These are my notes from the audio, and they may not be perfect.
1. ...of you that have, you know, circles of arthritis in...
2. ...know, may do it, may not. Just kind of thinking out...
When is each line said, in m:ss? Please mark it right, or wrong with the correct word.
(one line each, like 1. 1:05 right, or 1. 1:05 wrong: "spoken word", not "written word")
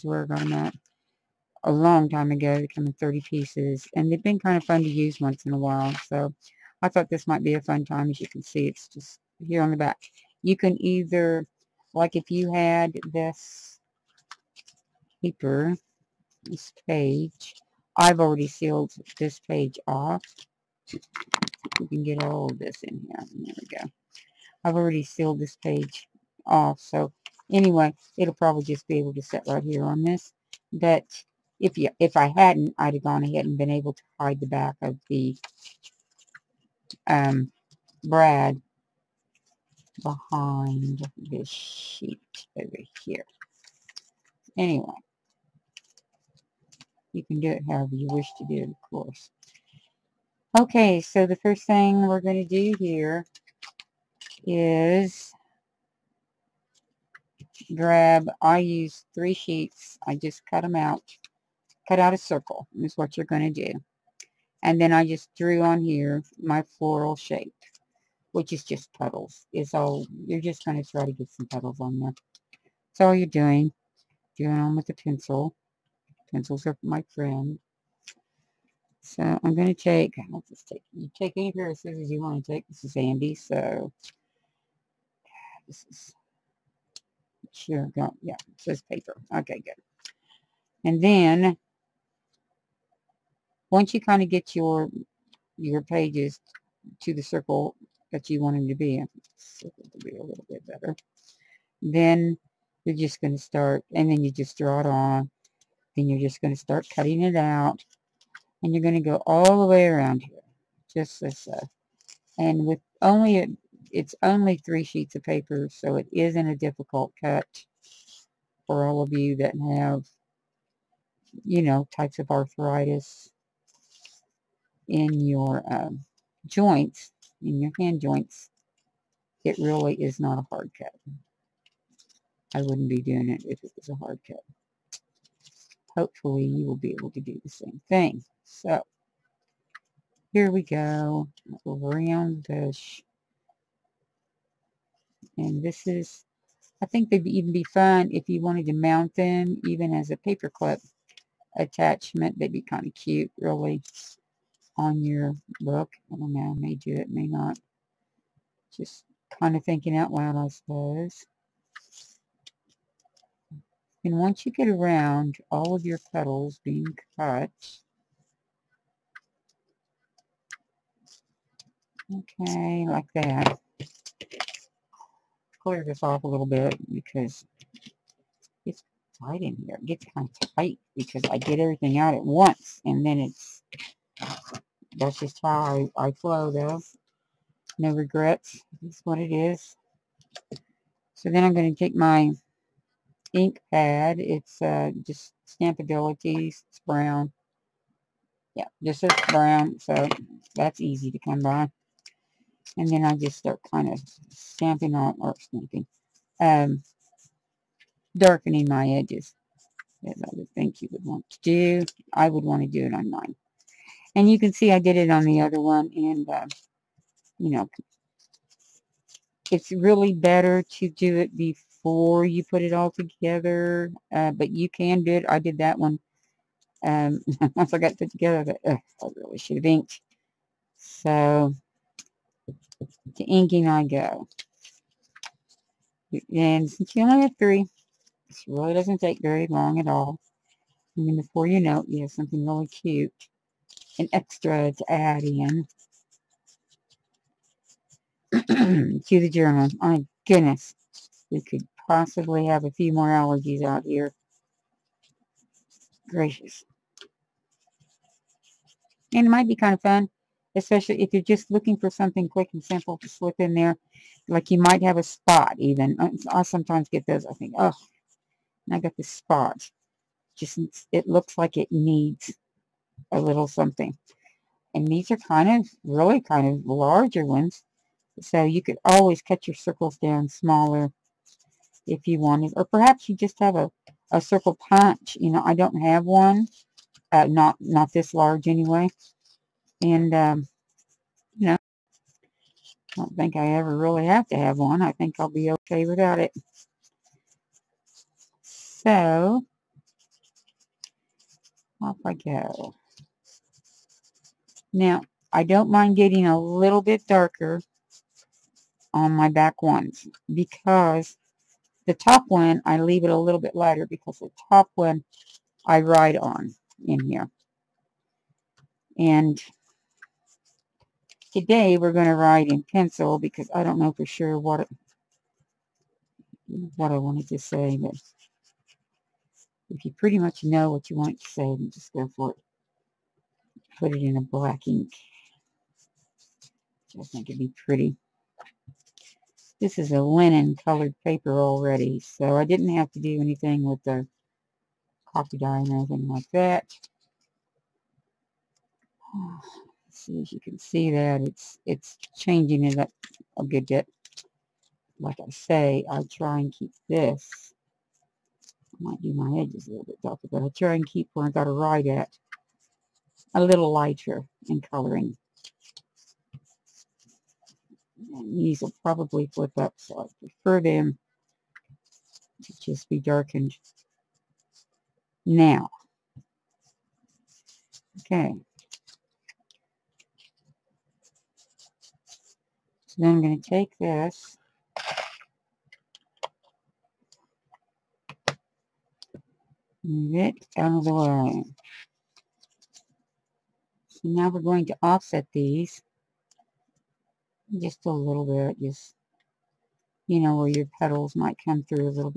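1. 1:59 wrong: "types", not "circles"
2. 2:36 right.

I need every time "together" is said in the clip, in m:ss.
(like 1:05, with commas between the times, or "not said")
3:42, 3:48.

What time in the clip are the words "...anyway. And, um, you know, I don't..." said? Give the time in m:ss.
4:48.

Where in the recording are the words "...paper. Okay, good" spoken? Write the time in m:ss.
1:28.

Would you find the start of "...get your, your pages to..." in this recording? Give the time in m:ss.
1:34.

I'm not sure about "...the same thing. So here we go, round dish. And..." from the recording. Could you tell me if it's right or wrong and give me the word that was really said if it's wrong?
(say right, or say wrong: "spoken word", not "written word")
right.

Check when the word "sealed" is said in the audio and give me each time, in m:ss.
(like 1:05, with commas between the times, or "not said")
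0:18, 0:25.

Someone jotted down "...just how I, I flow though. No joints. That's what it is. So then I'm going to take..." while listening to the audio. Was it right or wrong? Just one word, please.
wrong.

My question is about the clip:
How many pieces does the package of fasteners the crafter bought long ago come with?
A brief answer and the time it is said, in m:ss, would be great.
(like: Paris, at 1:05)
30, at 0:02.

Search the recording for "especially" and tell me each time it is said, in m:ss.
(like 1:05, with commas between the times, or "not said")
4:20.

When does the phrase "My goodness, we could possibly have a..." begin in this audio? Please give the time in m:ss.
4:09.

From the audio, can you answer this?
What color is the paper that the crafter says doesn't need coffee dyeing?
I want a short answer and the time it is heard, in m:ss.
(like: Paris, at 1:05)
linen, at 5:40.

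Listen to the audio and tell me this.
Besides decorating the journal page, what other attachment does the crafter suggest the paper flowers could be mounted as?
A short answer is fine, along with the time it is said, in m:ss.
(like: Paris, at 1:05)
paperclip, at 2:30.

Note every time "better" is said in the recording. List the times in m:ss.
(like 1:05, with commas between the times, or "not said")
1:40, 3:40.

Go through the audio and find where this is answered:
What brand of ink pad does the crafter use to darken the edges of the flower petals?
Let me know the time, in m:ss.
3:15.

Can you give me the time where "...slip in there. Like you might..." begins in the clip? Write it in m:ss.
4:23.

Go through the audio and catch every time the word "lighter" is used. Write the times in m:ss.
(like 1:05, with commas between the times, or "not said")
5:13, 6:03.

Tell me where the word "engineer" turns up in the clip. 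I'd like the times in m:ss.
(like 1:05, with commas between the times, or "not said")
not said.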